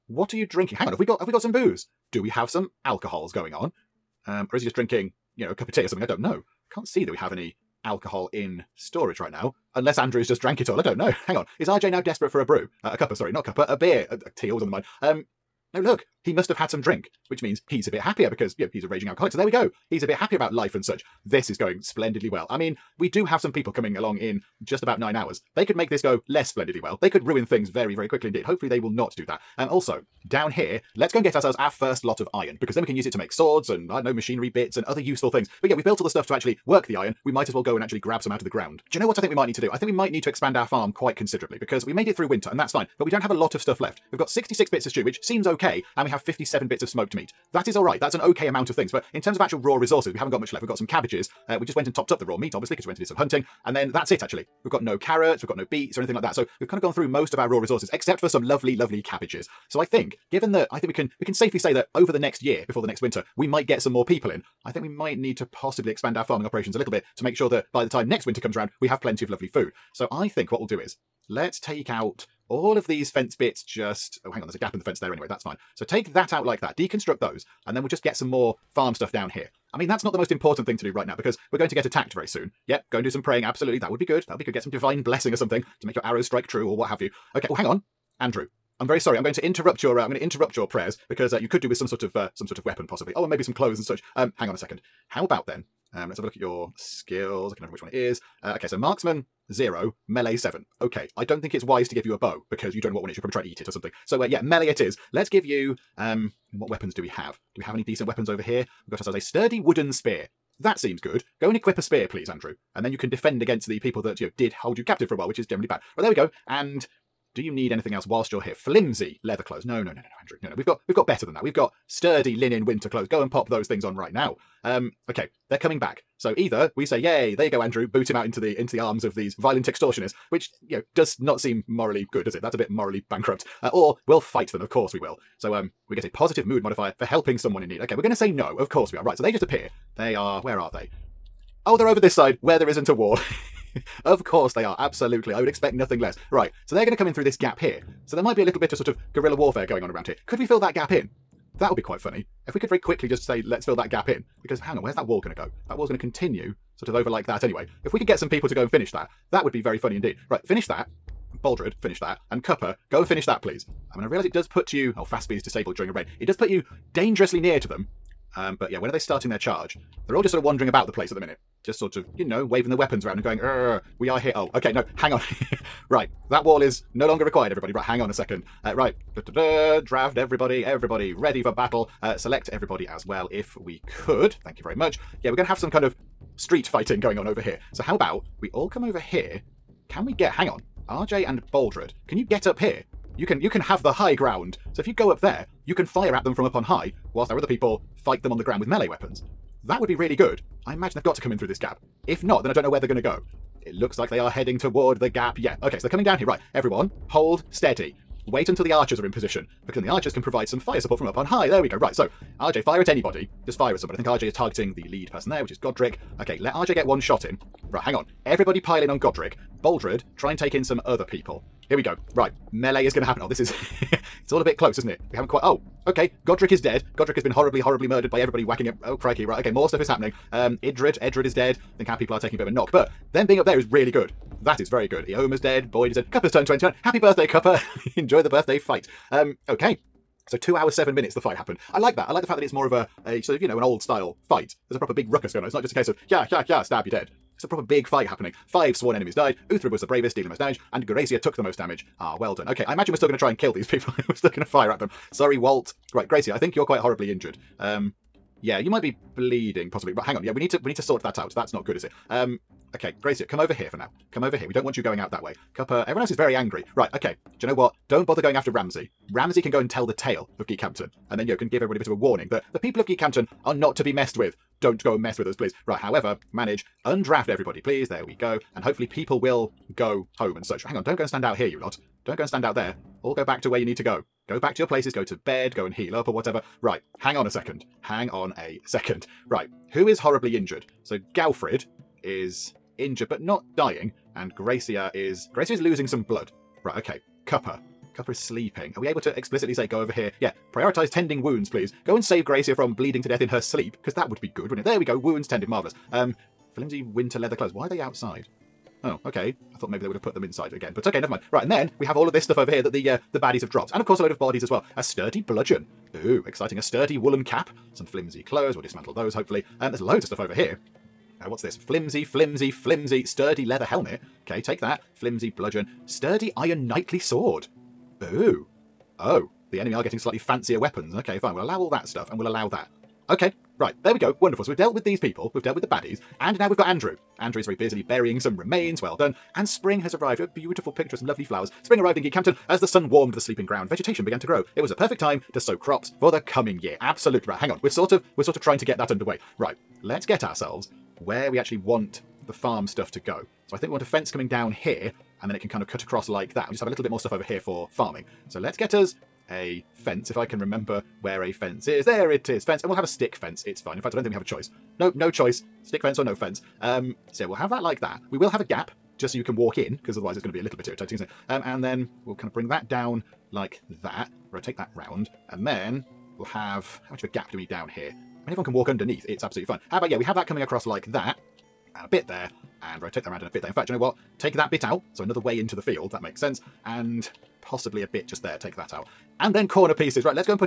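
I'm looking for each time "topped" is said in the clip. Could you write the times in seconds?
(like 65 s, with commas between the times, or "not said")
51 s.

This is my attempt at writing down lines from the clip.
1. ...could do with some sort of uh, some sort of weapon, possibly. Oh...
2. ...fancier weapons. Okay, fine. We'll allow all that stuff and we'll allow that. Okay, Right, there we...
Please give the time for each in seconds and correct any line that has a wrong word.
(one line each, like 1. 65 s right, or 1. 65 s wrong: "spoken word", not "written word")
1. 91 s right
2. 330 s right.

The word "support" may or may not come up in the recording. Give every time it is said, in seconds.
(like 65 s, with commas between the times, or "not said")
210 s.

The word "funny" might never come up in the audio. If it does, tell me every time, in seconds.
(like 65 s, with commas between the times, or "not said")
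151 s, 159 s.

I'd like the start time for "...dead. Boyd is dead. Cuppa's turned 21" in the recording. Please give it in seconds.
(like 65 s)
235 s.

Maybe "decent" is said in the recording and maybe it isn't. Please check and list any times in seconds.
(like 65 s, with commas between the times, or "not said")
107 s.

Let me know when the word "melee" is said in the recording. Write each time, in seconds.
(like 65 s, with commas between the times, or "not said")
100 s, 104 s, 198 s, 222 s.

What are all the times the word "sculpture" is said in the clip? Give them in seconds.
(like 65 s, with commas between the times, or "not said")
not said.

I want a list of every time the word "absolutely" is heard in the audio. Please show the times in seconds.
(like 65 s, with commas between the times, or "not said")
83 s, 144 s, 346 s, 379 s.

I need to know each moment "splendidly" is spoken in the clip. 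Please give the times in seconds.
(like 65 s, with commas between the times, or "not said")
21 s, 26 s.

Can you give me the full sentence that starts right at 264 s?
We don't want you going out that way.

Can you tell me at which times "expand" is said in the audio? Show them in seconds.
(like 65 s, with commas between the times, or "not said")
40 s, 65 s.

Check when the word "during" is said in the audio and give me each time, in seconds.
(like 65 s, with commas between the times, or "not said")
165 s.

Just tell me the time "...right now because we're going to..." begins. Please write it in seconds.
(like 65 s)
80 s.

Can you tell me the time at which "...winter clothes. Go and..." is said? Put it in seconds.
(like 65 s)
122 s.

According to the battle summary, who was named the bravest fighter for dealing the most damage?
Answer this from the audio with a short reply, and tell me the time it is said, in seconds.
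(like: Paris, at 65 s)
Uthrib, at 249 s.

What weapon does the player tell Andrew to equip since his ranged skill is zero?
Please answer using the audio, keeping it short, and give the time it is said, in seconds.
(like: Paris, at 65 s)
Sturdy wooden spear, at 109 s.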